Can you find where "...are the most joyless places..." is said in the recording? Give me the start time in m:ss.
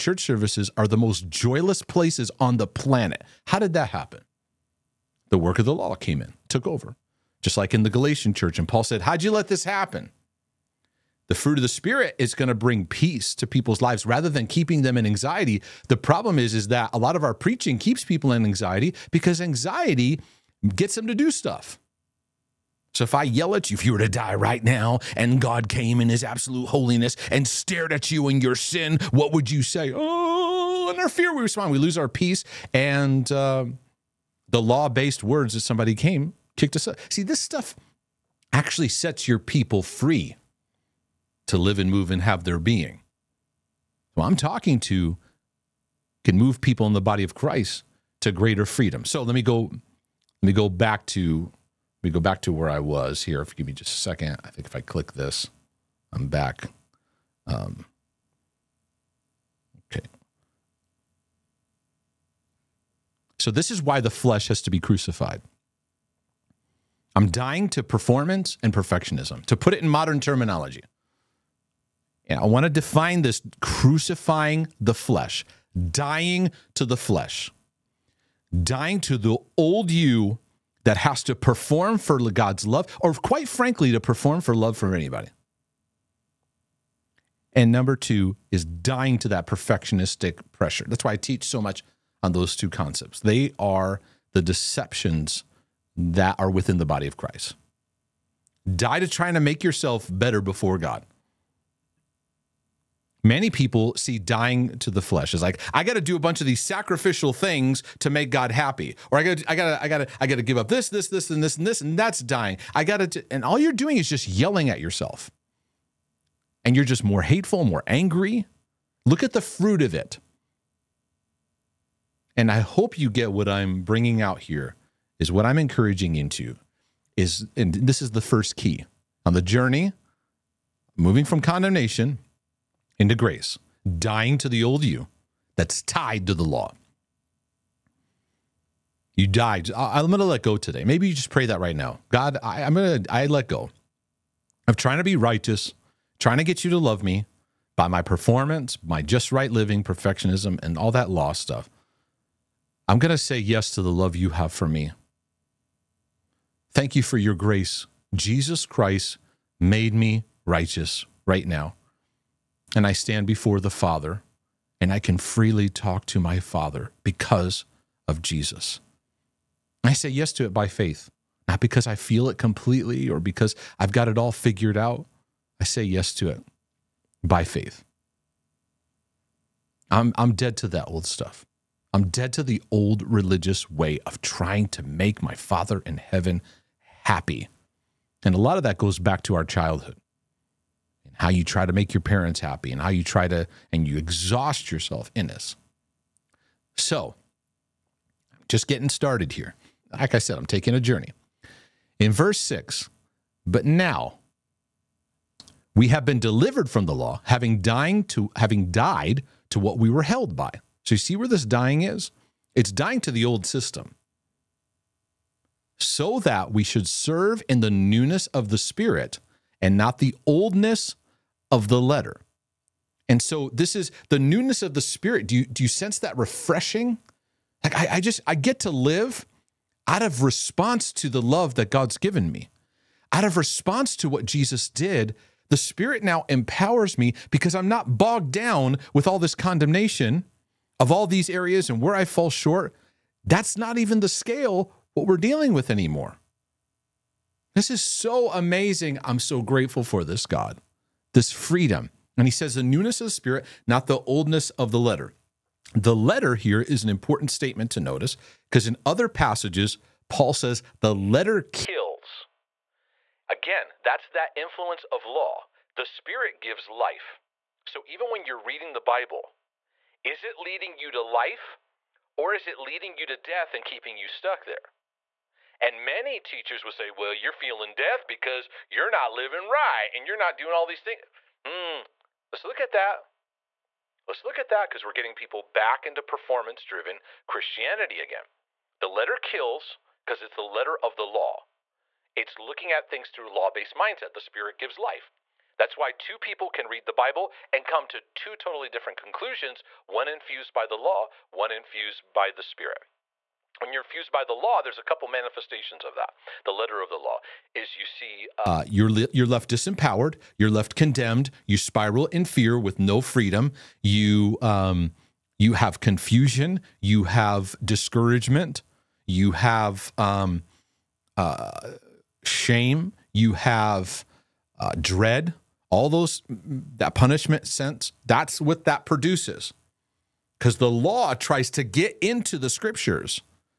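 0:00.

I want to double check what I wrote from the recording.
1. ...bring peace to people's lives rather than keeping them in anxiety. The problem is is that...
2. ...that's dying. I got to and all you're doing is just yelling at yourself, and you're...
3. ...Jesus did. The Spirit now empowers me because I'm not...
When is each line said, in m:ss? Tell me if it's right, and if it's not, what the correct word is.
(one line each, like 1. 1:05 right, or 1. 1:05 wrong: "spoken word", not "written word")
1. 0:12 right
2. 1:51 right
3. 3:54 right.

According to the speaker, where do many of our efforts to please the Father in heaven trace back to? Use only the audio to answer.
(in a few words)
our childhood.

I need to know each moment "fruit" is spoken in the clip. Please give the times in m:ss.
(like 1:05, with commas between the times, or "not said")
0:11, 1:59.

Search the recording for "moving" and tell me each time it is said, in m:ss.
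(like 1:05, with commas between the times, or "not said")
2:10.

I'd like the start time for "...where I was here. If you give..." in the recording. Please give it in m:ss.
0:52.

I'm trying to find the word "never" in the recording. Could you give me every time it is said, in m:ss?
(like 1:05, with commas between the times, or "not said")
not said.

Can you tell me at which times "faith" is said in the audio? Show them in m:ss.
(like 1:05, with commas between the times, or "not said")
2:50, 2:57.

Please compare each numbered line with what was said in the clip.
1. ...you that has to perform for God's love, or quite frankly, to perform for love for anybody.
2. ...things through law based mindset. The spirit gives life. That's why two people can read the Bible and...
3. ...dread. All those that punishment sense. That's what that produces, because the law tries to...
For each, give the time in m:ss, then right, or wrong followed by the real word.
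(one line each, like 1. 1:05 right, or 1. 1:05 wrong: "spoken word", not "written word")
1. 1:19 right
2. 4:52 right
3. 5:24 right.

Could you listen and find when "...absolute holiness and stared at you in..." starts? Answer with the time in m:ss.
0:26.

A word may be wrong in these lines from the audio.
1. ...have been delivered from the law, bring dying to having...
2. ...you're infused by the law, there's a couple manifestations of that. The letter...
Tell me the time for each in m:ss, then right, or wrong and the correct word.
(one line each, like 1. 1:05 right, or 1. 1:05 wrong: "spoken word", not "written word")
1. 3:25 wrong: "having", not "bring"
2. 5:03 right.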